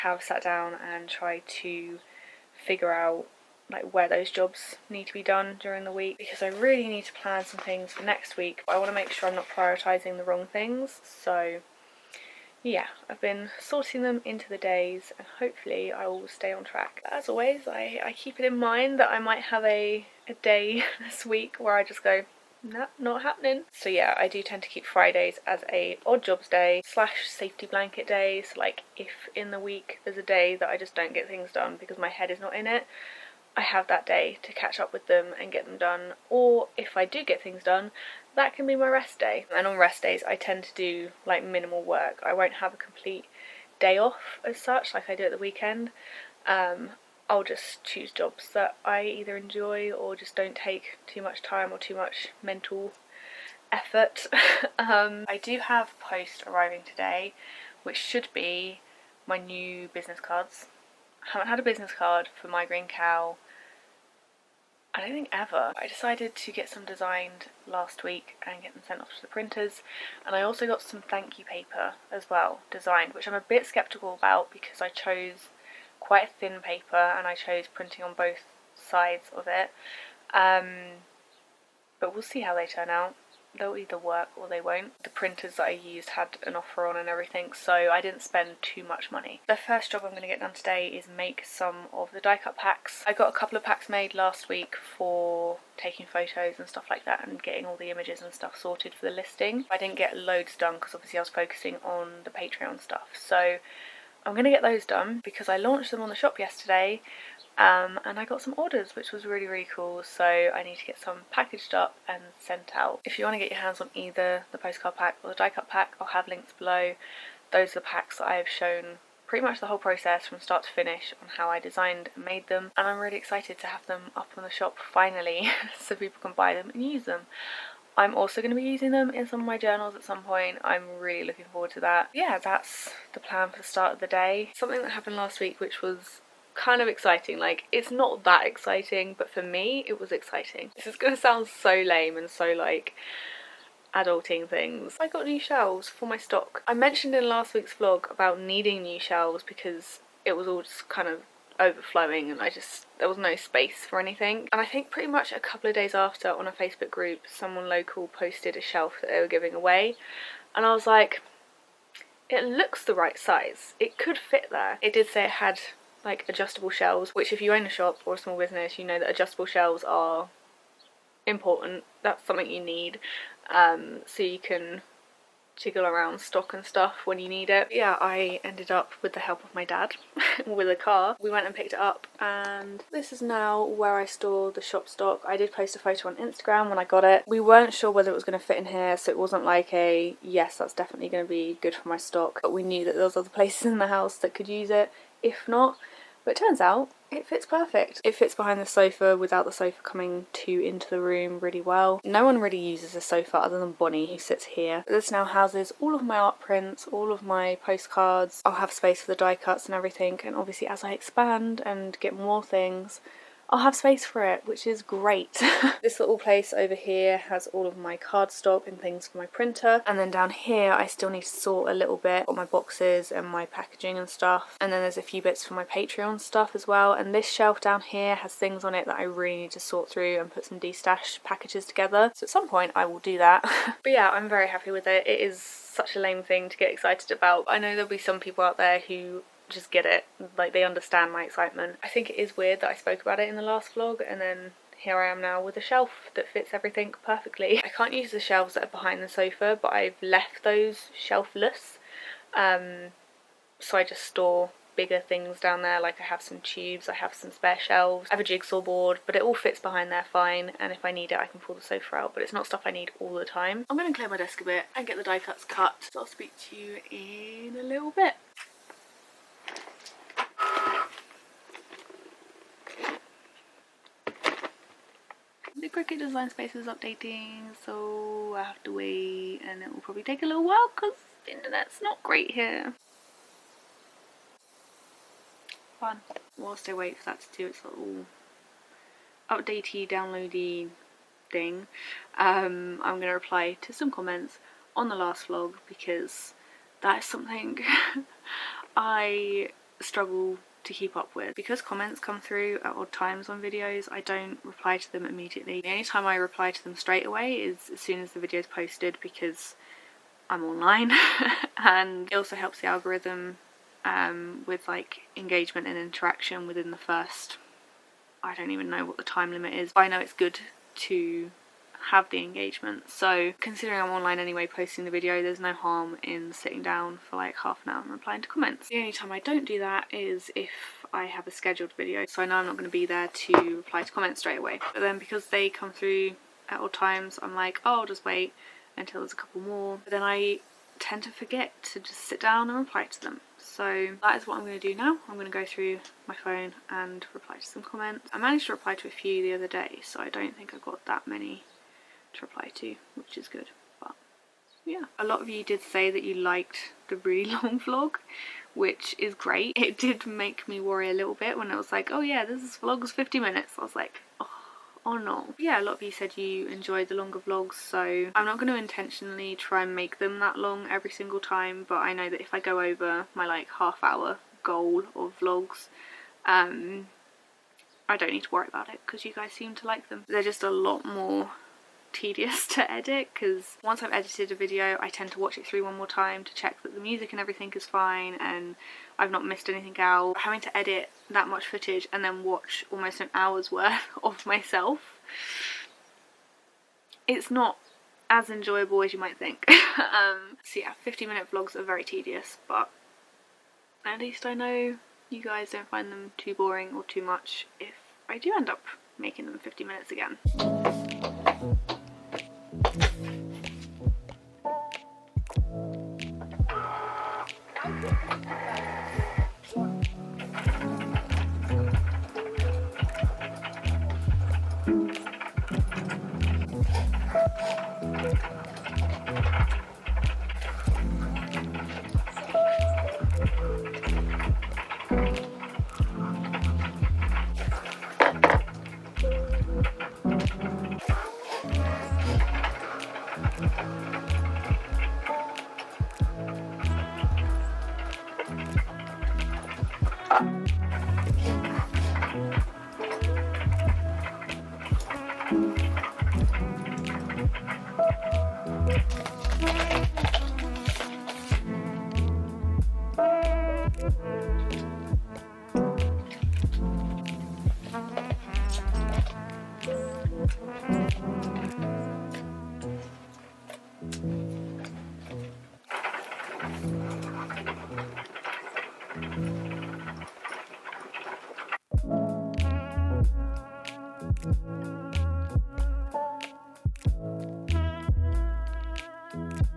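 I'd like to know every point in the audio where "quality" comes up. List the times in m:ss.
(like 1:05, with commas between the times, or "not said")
not said.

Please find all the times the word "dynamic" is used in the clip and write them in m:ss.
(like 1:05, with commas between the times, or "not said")
not said.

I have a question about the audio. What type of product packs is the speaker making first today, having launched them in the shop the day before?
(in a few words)
Die cut packs.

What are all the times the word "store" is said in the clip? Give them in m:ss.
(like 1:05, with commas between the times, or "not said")
3:04, 4:14.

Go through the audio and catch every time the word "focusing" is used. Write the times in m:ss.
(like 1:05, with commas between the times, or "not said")
1:41.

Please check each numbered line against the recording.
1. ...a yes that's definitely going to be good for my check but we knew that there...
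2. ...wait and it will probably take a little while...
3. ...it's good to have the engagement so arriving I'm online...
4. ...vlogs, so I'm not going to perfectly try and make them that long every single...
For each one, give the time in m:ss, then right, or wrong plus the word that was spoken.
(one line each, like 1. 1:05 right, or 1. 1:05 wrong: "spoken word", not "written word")
1. 3:09 wrong: "stock", not "check"
2. 4:38 right
3. 5:20 wrong: "considering", not "arriving"
4. 6:07 wrong: "intentionally", not "perfectly".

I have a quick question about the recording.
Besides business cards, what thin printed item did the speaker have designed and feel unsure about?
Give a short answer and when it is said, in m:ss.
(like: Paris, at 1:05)
Thank you paper, at 1:11.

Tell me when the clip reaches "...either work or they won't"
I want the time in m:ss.
1:23.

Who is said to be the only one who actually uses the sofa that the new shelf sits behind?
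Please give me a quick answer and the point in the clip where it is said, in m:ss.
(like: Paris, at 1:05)
Bonnie, at 3:23.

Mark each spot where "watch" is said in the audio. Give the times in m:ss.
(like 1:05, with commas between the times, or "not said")
6:25, 6:32.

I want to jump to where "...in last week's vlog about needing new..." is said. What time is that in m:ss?
2:27.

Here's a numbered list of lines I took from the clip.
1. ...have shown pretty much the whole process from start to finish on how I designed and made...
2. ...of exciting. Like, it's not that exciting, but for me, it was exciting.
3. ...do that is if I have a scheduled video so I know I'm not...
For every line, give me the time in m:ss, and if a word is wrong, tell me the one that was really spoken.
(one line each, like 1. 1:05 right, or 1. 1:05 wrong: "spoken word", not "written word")
1. 1:58 right
2. 2:16 right
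3. 5:29 right.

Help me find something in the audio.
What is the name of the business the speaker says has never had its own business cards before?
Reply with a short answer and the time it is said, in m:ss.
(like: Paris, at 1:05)
MyGreenCow, at 1:02.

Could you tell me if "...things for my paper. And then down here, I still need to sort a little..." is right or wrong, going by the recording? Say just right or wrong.
wrong.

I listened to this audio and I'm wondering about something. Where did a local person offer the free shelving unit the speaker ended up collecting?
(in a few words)
A Facebook group.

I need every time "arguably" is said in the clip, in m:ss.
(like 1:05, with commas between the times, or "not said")
not said.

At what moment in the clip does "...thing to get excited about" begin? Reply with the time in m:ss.
3:56.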